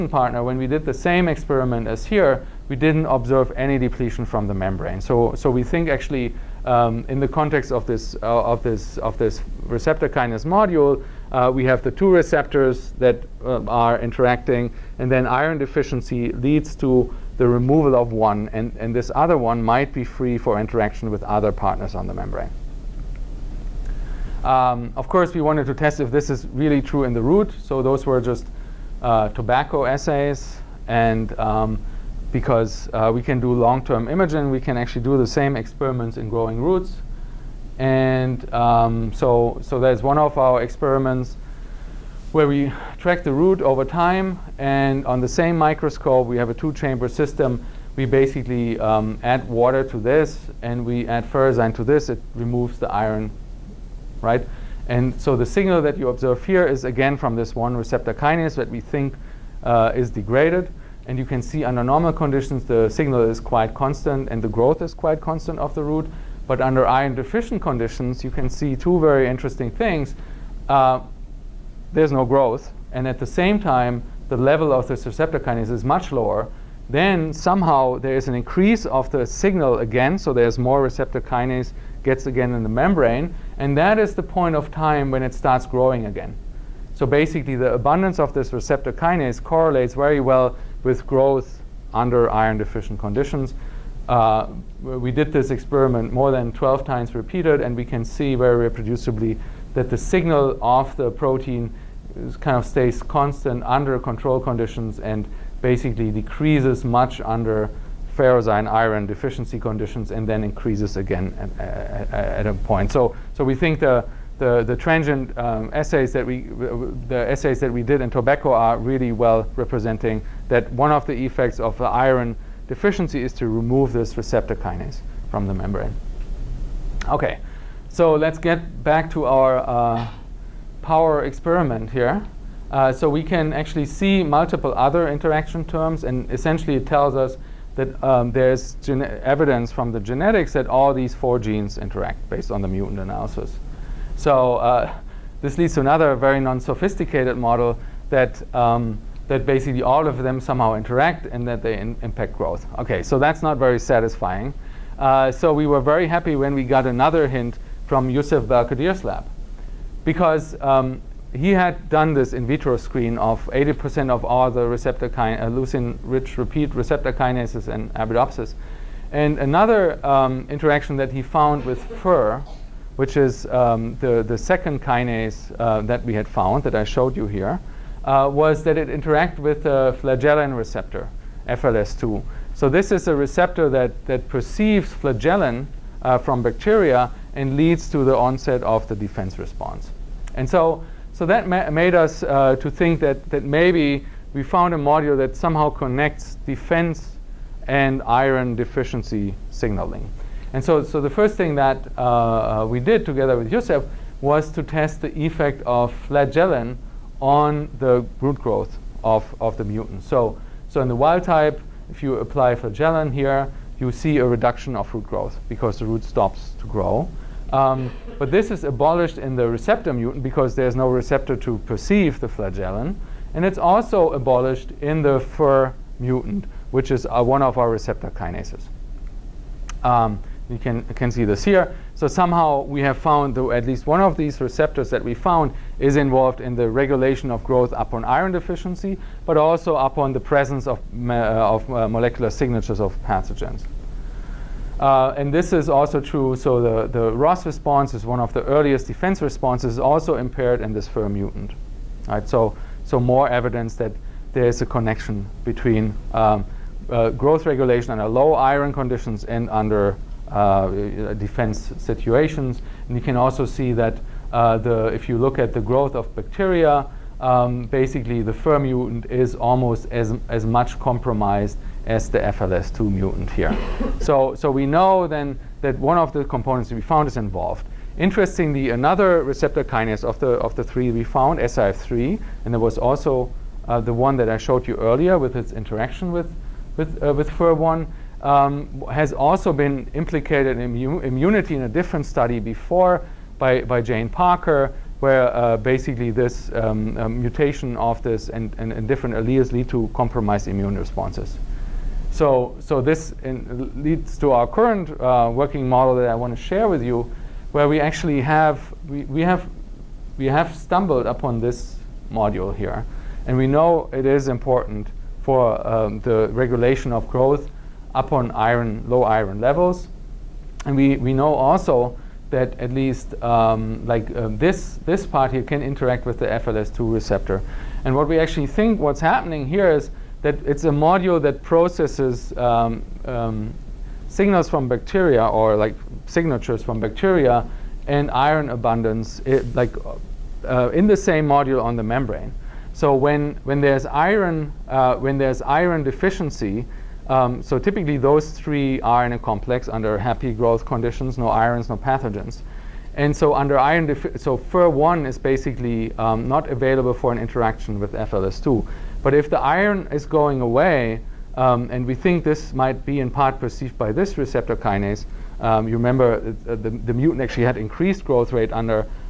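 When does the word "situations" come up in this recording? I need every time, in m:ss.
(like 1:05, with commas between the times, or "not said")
4:21.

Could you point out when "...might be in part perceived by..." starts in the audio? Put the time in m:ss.
6:02.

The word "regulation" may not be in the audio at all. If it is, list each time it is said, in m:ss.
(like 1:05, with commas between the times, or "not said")
3:56, 4:17, 5:16.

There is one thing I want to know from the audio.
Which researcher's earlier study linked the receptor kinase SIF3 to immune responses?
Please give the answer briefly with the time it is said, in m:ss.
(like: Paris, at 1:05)
Jane Parker, at 4:53.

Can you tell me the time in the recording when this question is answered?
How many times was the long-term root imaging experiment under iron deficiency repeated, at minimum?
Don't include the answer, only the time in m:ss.
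1:36.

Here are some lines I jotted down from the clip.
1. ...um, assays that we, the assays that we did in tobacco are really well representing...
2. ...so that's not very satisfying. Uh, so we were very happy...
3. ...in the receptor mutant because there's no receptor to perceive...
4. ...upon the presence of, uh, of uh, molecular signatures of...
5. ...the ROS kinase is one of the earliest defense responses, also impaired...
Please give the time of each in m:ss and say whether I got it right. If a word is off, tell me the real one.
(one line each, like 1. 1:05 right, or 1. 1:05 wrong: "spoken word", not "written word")
1. 1:55 right
2. 2:33 right
3. 3:39 right
4. 3:59 right
5. 4:06 wrong: "response", not "kinase".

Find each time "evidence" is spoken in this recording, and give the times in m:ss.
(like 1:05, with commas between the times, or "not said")
2:19, 4:13.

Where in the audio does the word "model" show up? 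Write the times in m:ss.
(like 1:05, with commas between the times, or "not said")
2:27, 5:05.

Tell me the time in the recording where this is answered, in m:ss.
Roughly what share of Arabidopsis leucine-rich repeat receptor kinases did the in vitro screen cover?
2:43.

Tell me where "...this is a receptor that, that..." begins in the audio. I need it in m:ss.
3:02.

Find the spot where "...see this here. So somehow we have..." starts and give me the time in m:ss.
3:51.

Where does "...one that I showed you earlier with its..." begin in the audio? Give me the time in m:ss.
4:43.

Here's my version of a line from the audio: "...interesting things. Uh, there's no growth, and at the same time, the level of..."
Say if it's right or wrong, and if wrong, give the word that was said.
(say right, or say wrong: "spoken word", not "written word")
right.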